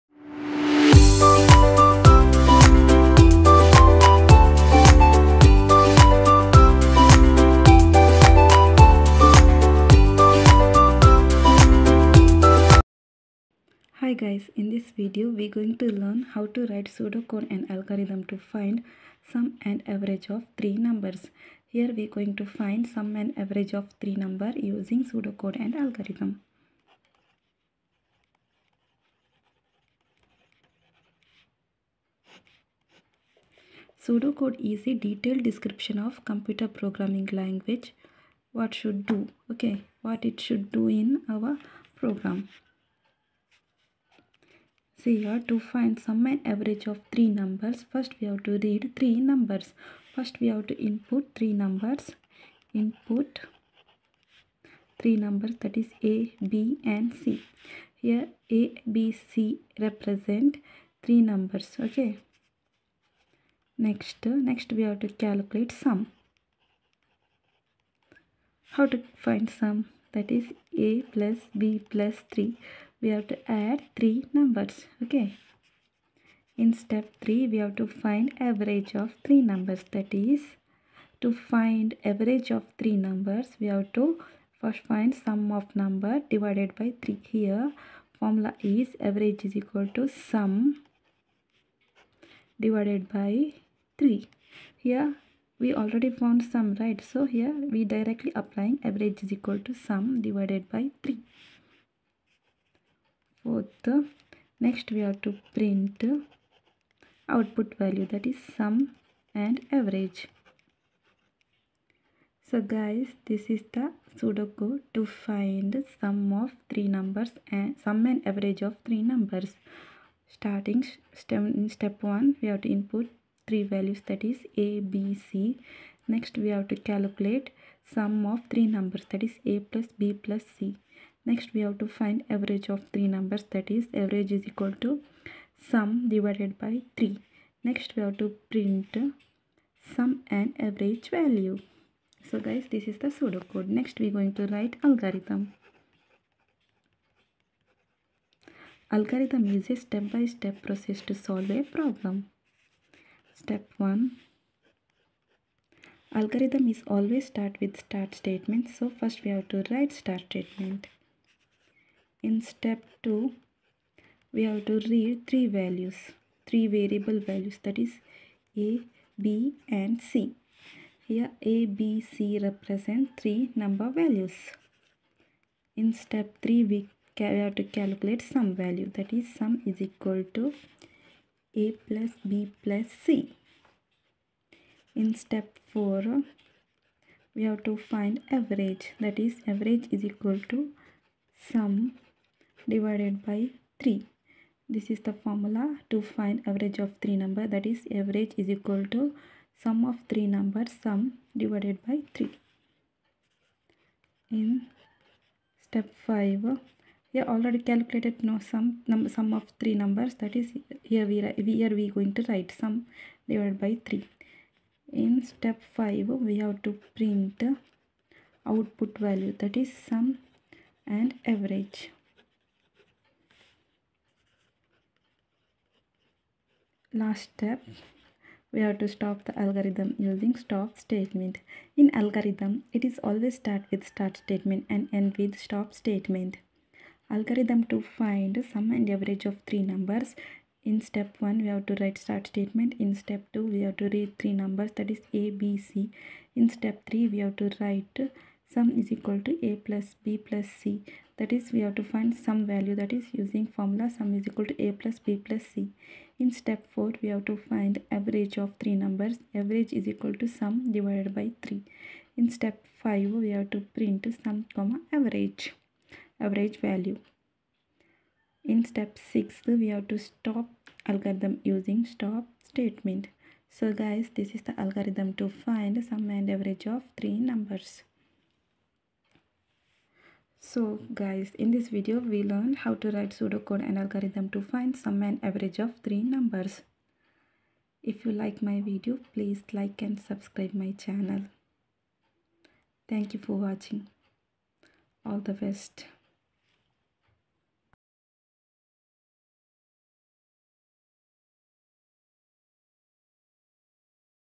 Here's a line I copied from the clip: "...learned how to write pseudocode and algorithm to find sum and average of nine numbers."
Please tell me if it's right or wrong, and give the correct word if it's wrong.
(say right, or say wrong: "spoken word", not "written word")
wrong: "three", not "nine".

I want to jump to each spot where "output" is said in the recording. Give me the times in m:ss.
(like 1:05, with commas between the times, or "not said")
1:47, 3:38.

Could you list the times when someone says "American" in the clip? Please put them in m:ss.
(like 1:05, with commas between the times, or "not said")
not said.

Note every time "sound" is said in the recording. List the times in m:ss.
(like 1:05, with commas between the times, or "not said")
not said.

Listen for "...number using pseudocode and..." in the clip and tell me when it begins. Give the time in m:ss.
0:24.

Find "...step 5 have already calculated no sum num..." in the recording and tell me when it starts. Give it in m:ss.
3:25.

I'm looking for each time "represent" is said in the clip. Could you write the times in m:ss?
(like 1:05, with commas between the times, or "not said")
0:59, 2:52.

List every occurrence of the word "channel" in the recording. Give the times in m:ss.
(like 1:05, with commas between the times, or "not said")
4:50.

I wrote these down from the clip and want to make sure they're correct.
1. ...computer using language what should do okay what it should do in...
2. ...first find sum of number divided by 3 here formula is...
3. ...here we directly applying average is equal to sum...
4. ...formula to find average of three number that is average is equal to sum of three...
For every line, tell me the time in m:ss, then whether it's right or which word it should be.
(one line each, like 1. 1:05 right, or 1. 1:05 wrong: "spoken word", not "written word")
1. 0:36 wrong: "programming", not "using"
2. 1:24 right
3. 1:37 right
4. 3:15 right.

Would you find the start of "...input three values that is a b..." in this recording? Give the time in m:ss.
2:02.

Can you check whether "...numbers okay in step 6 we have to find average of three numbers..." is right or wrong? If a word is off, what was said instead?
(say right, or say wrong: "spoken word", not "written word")
wrong: "3", not "6".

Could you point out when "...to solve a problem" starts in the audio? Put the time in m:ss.
2:31.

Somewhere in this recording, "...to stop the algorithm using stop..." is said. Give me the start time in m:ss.
3:48.